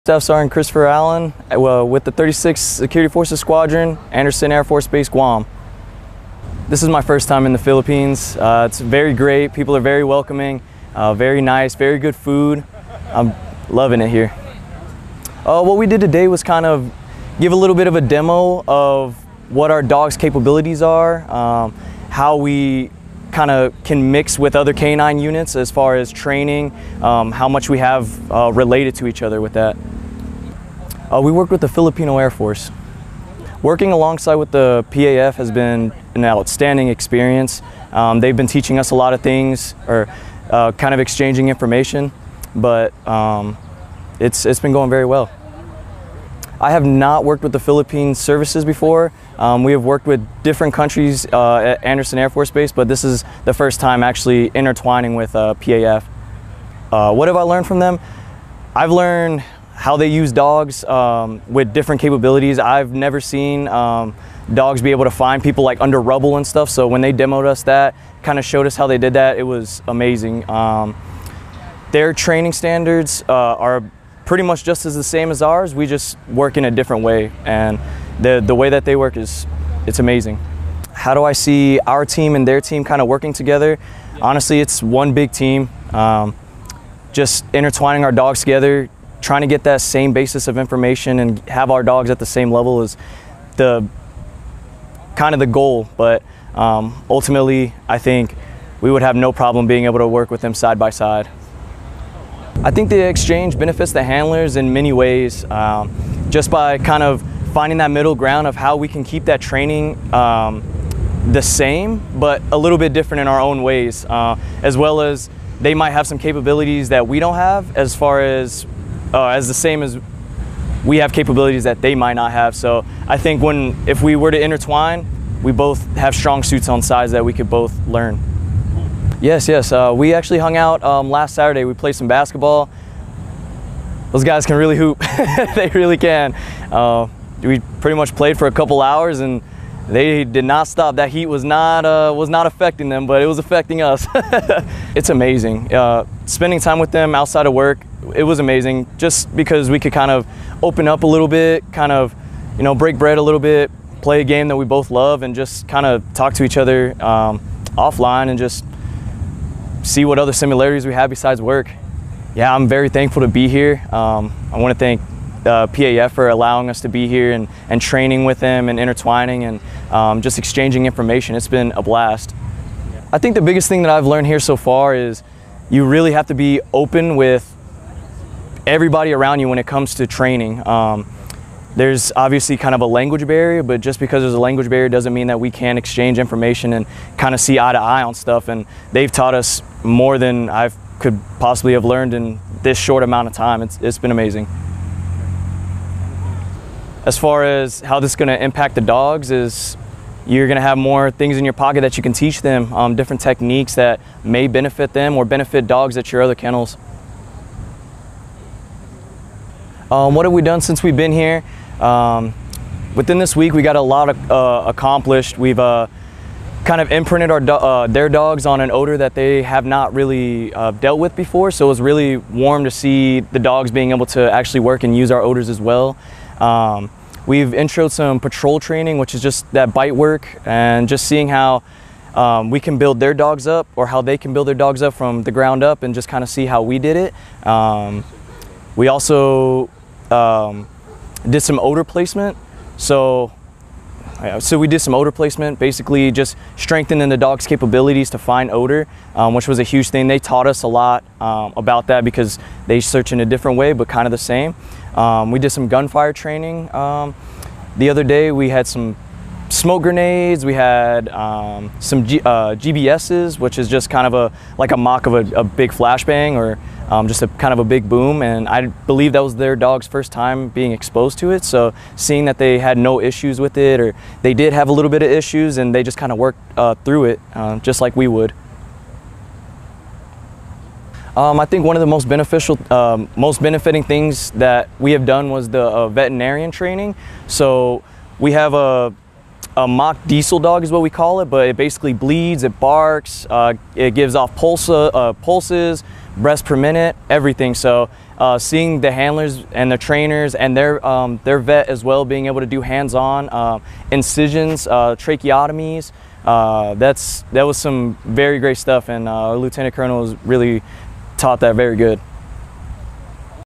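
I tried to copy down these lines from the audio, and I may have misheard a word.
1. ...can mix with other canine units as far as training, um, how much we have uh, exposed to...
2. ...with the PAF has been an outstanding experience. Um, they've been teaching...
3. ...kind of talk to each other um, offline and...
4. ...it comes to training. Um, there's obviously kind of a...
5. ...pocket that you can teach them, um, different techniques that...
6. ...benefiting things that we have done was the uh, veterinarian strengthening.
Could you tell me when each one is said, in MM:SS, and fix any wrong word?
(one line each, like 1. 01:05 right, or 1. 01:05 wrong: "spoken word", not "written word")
1. 00:23 wrong: "related", not "exposed"
2. 00:34 right
3. 02:35 right
4. 02:59 right
5. 03:21 right
6. 04:43 wrong: "training", not "strengthening".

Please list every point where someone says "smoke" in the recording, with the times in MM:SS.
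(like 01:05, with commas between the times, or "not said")
04:19.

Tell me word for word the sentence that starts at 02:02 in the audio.
So I think when if we were to intertwine, we both have strong suits on sides that we could both learn.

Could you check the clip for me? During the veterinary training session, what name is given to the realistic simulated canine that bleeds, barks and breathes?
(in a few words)
Diesel dog.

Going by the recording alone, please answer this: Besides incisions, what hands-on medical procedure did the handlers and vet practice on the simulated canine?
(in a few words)
Tracheotomies.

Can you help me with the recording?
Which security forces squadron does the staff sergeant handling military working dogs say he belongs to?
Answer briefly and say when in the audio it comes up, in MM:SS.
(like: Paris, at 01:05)
36th Security Forces Squadron, at 00:02.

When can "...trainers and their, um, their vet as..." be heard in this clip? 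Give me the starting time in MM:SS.
04:59.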